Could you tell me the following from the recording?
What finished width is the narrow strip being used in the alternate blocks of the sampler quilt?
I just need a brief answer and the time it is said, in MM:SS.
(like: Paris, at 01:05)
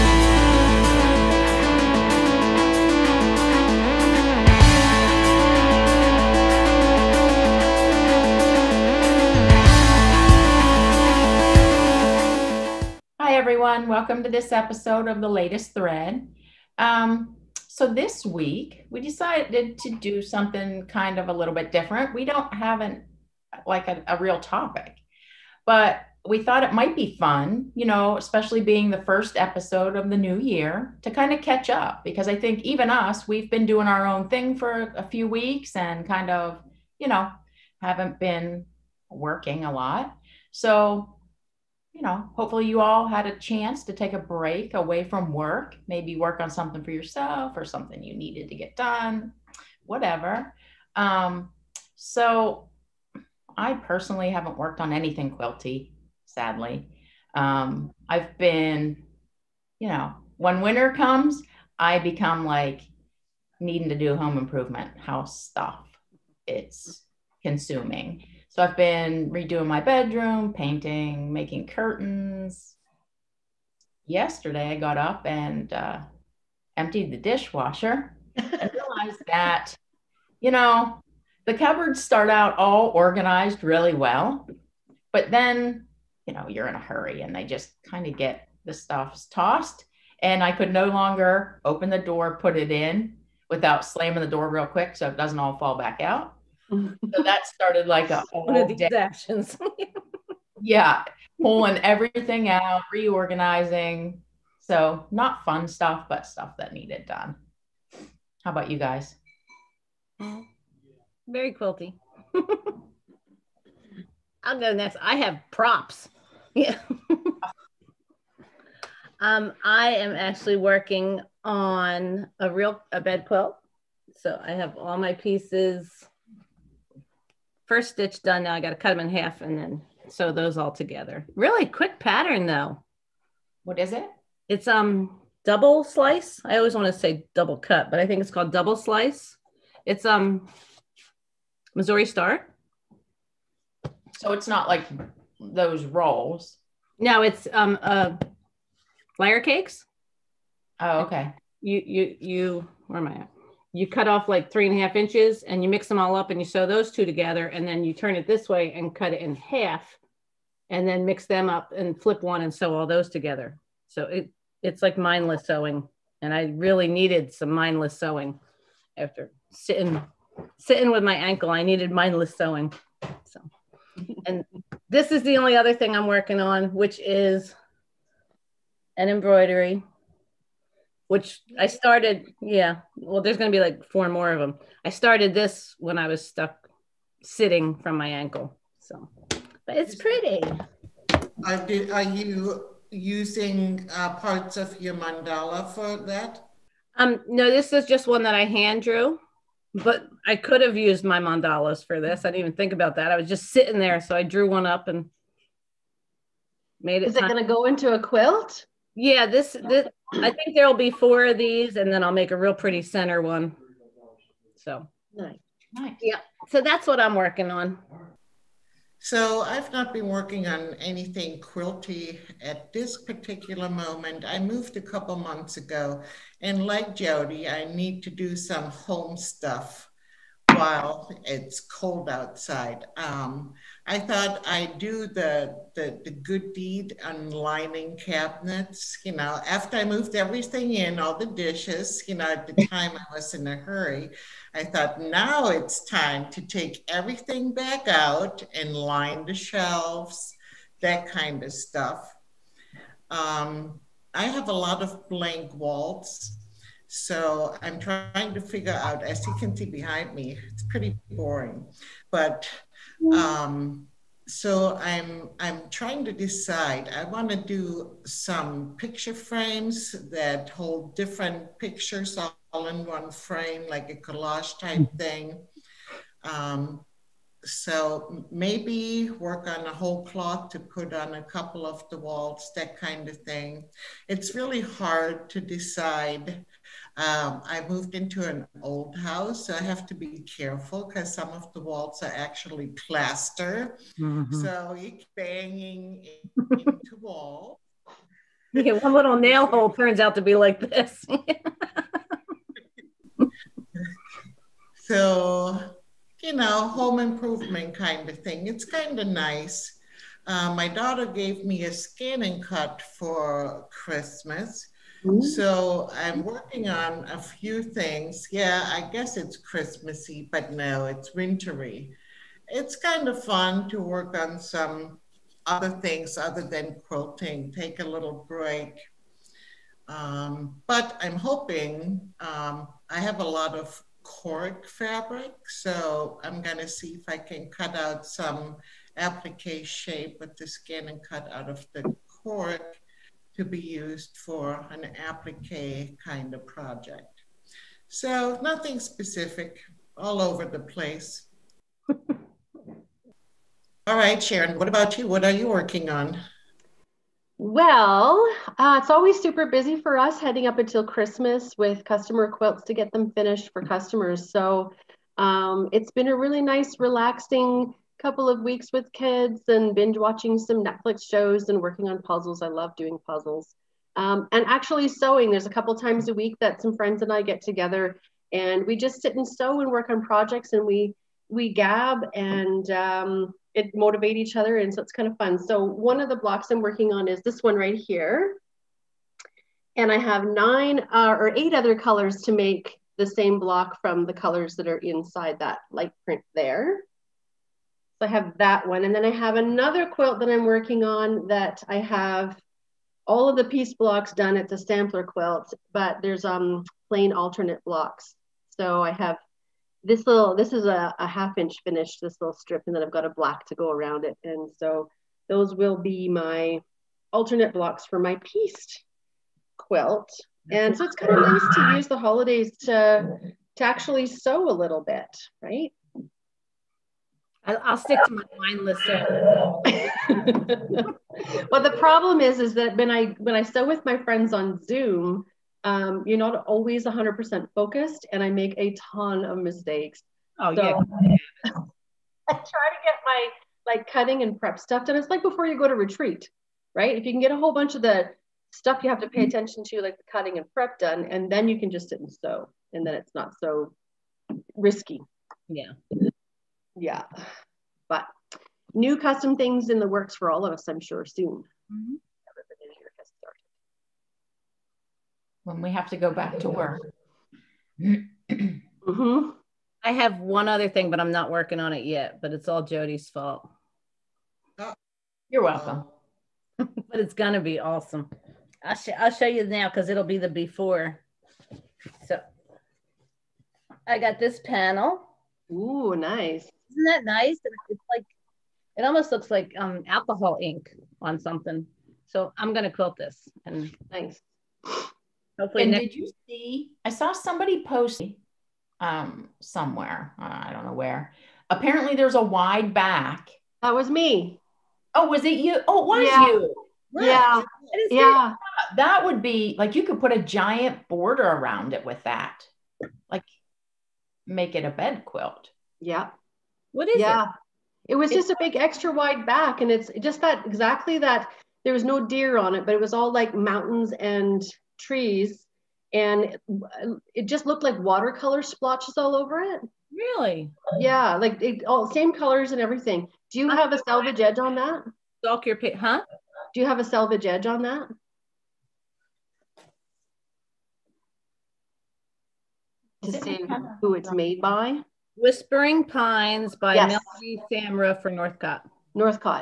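Half inch, at 06:51.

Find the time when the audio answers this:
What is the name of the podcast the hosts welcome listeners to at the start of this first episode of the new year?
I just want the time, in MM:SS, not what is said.
00:15.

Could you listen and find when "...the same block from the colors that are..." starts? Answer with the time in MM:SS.
06:32.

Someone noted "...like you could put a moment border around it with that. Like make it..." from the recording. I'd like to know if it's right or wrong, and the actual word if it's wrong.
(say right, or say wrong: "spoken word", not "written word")
wrong: "giant", not "moment".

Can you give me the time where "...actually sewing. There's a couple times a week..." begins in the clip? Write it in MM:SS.
06:14.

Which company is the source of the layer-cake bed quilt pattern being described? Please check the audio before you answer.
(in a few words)
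Missouri Star.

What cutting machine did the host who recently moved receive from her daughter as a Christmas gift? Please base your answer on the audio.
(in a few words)
ScanNCut.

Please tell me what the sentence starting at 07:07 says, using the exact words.
I'll, I'll stick to my mindless.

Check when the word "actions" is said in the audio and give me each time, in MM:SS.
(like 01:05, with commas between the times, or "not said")
01:38.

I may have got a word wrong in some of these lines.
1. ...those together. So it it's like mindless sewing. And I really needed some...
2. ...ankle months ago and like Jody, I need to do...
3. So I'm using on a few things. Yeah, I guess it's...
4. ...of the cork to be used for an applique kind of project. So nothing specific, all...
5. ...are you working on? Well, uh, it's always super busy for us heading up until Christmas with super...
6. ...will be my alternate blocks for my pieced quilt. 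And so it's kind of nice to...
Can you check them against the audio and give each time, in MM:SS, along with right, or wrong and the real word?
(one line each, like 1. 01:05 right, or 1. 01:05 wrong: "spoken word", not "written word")
1. 02:42 right
2. 03:44 wrong: "couple", not "ankle"
3. 05:15 wrong: "working", not "using"
4. 05:41 right
5. 05:55 wrong: "customer", not "super"
6. 06:55 right.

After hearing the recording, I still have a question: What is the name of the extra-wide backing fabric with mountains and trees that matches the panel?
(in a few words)
Whispering Pines.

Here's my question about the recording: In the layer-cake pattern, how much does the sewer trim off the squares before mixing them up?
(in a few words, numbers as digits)
3.5 inches.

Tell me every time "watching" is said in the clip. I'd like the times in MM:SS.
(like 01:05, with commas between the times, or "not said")
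06:09.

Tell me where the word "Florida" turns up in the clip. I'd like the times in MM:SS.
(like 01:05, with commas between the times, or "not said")
not said.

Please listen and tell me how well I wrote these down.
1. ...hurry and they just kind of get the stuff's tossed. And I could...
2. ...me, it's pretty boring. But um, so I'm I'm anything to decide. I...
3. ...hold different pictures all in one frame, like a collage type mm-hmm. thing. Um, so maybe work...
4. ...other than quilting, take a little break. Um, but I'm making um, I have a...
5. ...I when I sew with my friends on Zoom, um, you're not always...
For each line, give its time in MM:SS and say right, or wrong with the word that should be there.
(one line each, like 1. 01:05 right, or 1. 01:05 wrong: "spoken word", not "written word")
1. 01:26 right
2. 04:20 wrong: "trying", not "anything"
3. 04:30 right
4. 05:26 wrong: "hoping", not "making"
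5. 07:12 right.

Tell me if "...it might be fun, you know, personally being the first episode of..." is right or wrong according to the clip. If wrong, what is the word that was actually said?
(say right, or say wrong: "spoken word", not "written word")
wrong: "especially", not "personally".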